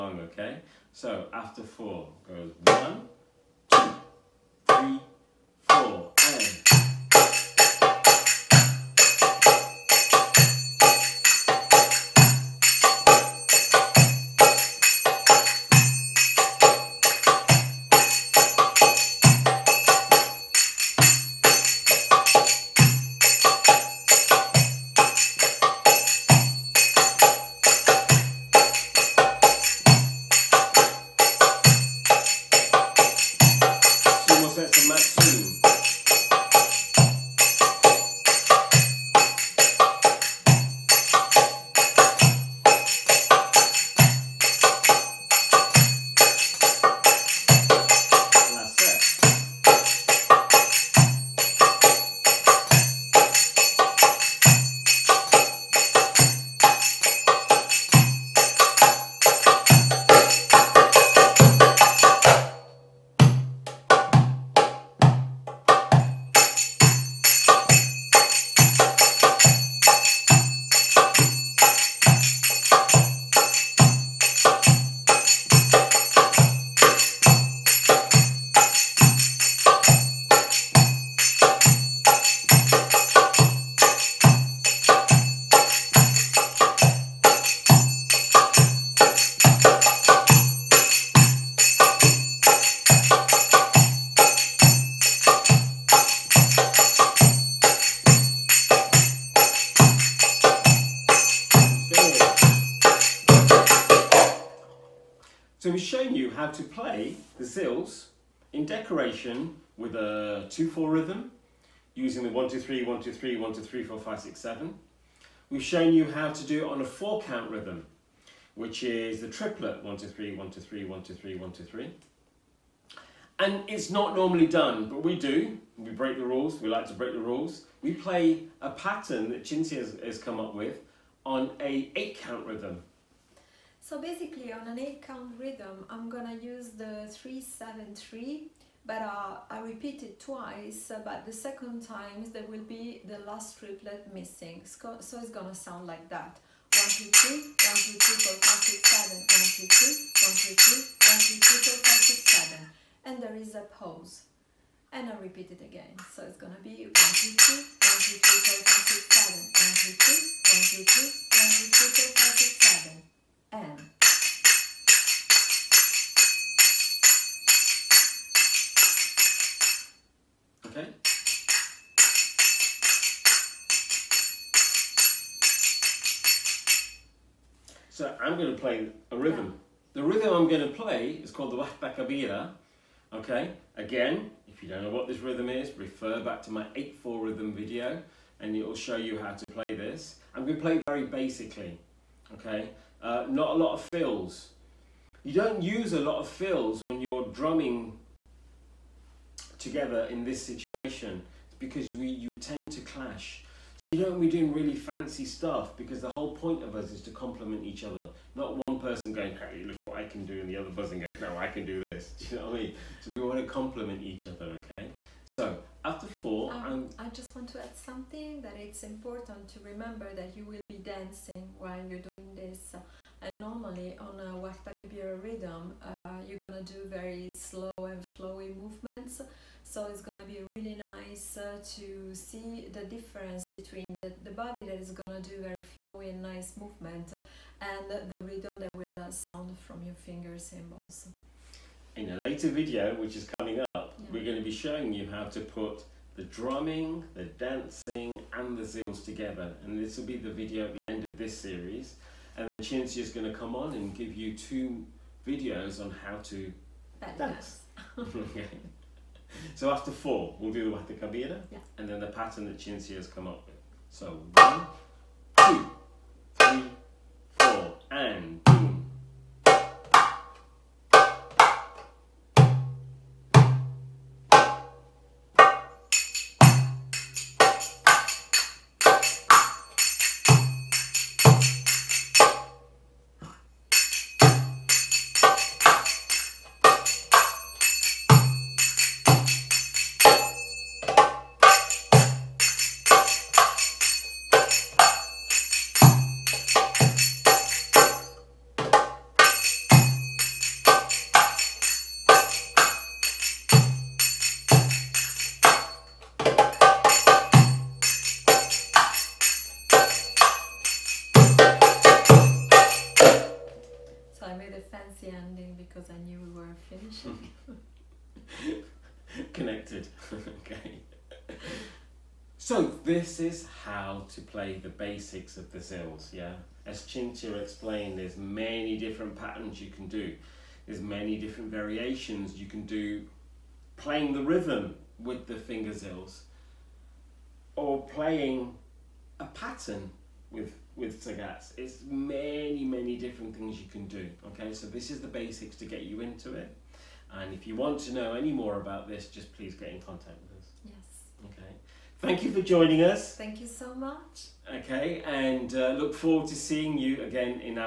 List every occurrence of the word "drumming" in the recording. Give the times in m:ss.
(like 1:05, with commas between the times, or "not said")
3:17, 4:06.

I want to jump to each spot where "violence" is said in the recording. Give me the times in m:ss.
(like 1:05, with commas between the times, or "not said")
not said.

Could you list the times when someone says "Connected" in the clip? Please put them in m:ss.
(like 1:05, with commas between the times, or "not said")
5:19.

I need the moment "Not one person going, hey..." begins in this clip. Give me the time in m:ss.
3:28.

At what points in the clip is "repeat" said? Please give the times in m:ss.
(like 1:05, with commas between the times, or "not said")
2:19, 2:35.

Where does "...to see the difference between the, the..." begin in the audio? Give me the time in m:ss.
3:51.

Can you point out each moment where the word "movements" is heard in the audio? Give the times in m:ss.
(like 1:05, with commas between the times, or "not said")
3:48, 3:56.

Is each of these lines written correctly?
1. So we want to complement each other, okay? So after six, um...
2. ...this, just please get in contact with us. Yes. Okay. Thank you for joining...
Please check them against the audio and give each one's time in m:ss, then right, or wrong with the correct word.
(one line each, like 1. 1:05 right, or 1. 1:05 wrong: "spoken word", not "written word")
1. 3:33 wrong: "four", not "six"
2. 5:48 right.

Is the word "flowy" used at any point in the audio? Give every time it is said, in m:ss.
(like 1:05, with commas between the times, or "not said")
3:48, 3:55.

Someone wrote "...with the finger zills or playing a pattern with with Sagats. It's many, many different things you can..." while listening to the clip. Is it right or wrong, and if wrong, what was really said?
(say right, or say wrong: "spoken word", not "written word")
right.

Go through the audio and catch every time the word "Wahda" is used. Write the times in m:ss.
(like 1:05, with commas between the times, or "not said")
3:01, 3:44, 4:20.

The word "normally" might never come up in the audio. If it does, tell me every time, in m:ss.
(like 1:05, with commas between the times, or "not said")
2:04, 3:43.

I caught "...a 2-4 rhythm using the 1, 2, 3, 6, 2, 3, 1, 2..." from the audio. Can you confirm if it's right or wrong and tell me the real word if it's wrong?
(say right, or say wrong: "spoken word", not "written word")
wrong: "1", not "6".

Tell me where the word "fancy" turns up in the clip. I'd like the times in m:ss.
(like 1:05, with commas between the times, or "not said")
3:24.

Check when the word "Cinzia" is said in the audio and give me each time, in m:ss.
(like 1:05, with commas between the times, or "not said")
2:09, 4:12, 4:22, 5:26.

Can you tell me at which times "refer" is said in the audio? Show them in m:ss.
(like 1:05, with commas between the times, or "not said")
3:05.